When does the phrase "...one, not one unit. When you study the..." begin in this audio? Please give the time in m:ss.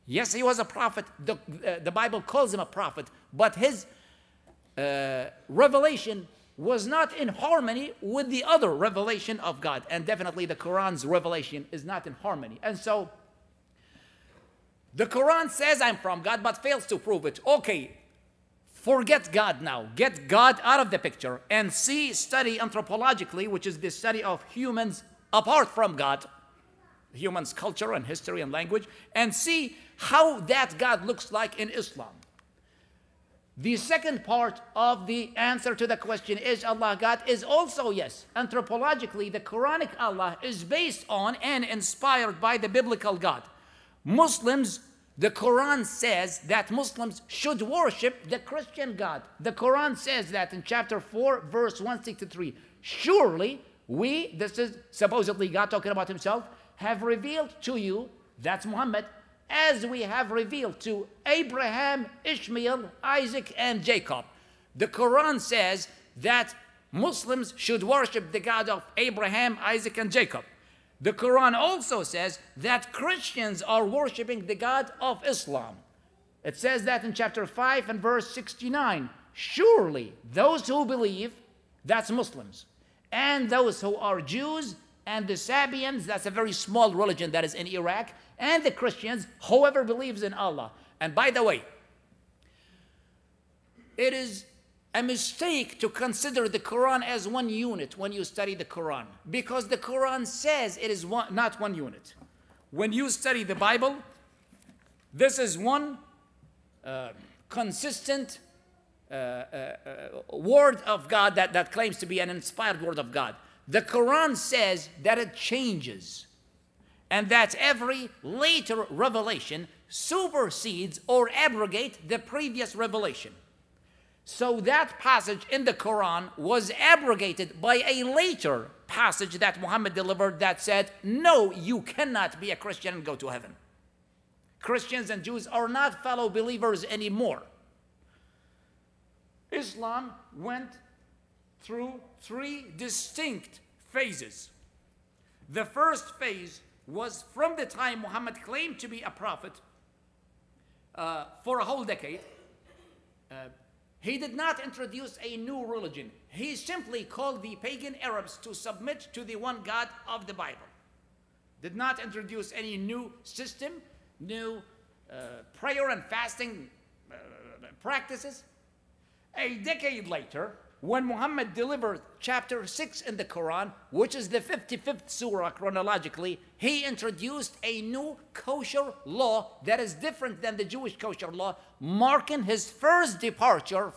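1:41.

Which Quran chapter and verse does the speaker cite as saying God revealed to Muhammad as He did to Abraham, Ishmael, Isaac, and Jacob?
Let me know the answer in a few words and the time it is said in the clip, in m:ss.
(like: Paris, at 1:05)
Chapter 4, verse 163, at 0:50.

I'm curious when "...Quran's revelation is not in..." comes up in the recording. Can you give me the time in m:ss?
0:10.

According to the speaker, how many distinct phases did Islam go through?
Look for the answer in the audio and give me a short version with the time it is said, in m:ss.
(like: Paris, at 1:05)
3, at 2:22.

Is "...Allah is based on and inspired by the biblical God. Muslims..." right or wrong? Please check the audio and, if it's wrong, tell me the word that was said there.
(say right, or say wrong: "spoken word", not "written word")
right.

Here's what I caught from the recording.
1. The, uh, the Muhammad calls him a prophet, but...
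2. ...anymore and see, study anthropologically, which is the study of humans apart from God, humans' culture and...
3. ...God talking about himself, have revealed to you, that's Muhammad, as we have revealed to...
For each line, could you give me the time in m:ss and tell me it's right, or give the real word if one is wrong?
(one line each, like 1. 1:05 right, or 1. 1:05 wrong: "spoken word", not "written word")
1. 0:01 wrong: "Bible", not "Muhammad"
2. 0:20 wrong: "picture", not "anymore"
3. 0:55 right.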